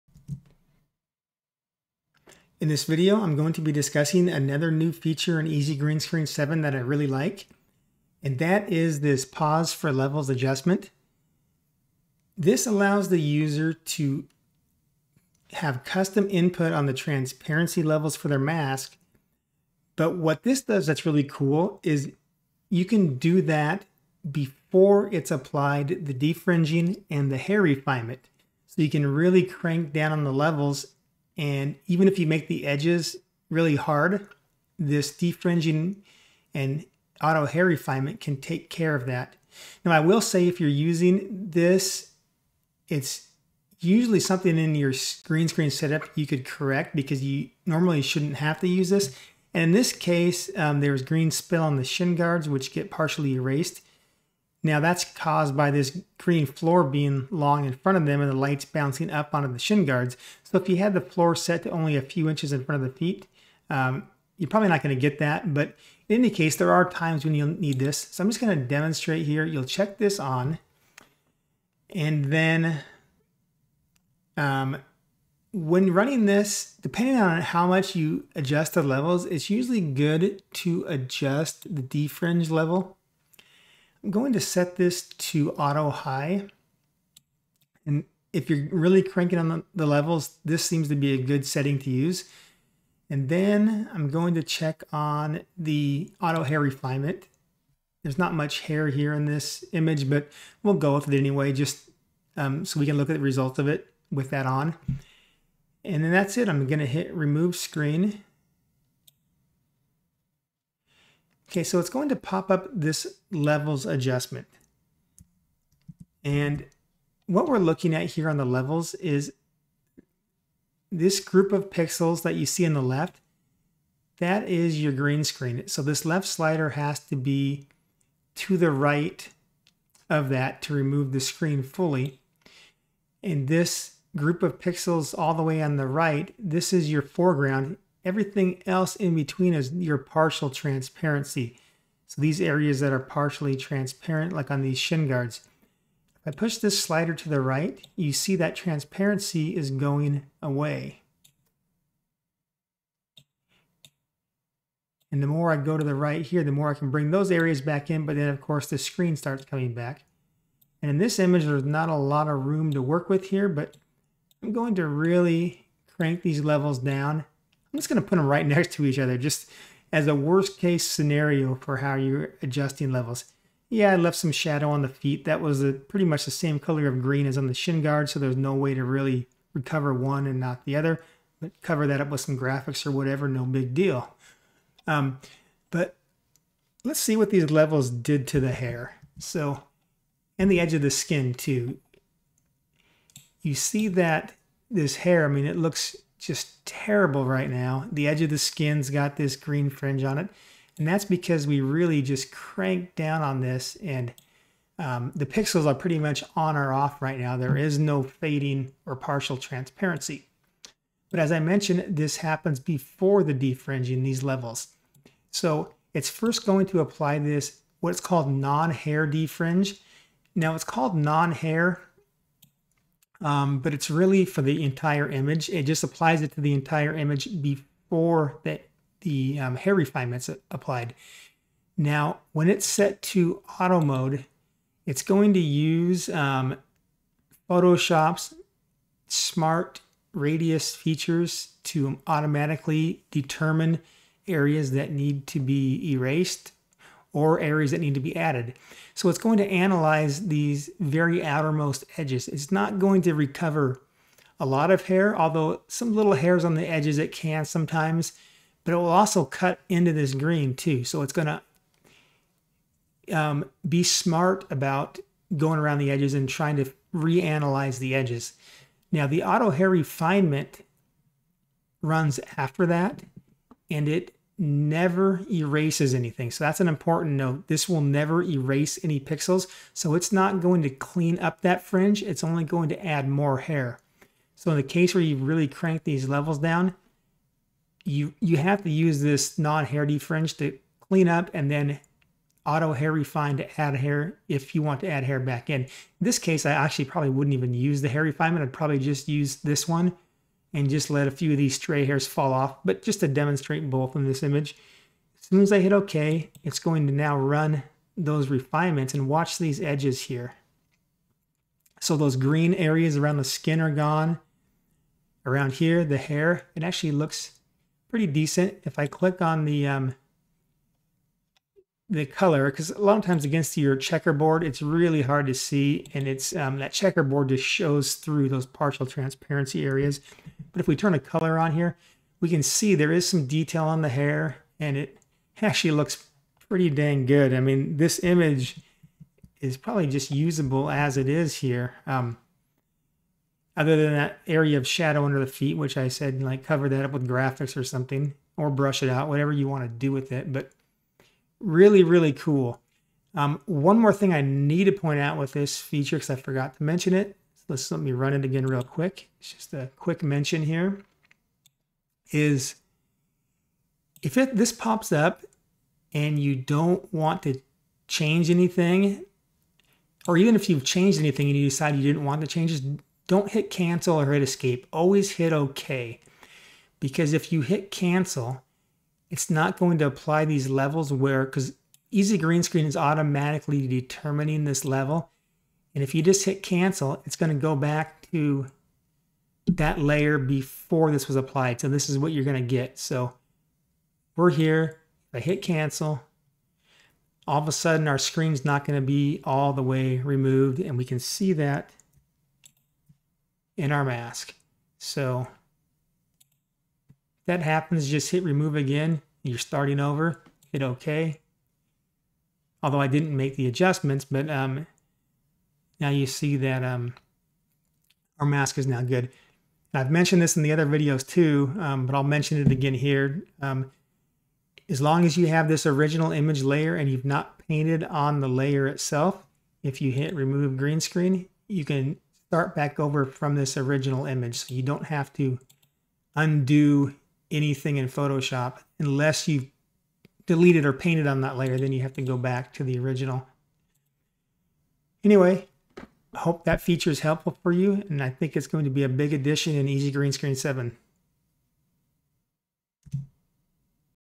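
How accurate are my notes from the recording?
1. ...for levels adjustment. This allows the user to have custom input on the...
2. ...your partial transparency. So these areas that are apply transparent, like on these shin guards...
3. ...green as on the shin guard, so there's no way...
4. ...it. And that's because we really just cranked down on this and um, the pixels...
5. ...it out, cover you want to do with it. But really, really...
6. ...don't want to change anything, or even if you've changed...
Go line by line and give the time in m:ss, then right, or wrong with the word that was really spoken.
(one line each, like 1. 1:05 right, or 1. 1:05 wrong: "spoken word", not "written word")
1. 0:09 right
2. 2:19 wrong: "partially", not "apply"
3. 2:57 right
4. 3:20 right
5. 5:48 wrong: "whatever", not "cover"
6. 6:06 right.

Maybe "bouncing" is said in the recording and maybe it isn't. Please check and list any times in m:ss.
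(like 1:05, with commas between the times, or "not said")
0:58.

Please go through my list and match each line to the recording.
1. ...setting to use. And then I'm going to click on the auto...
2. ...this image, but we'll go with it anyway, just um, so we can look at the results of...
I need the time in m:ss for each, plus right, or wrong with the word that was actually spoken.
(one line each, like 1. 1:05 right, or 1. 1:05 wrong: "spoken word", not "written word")
1. 1:31 wrong: "check", not "click"
2. 1:39 right.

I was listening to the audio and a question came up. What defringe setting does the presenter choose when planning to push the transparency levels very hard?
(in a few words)
Auto high.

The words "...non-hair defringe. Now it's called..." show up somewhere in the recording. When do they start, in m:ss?
3:38.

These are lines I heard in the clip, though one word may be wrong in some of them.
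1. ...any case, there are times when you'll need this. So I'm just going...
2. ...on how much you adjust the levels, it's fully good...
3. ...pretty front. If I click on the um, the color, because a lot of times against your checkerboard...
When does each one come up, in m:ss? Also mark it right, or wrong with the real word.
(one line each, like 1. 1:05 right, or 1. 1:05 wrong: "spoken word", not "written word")
1. 1:06 right
2. 1:17 wrong: "usually", not "fully"
3. 5:17 wrong: "decent", not "front".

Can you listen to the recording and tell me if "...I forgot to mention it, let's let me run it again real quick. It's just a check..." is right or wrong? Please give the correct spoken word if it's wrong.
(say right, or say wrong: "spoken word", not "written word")
wrong: "quick", not "check".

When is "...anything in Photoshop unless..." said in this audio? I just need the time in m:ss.
7:17.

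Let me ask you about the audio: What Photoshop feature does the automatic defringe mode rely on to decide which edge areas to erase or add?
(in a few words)
Smart radius.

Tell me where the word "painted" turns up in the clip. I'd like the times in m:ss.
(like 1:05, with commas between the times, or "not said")
7:07, 7:20.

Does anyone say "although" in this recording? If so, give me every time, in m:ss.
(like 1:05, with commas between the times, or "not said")
4:15, 6:52.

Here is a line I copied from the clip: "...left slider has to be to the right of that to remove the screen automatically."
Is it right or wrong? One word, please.
wrong.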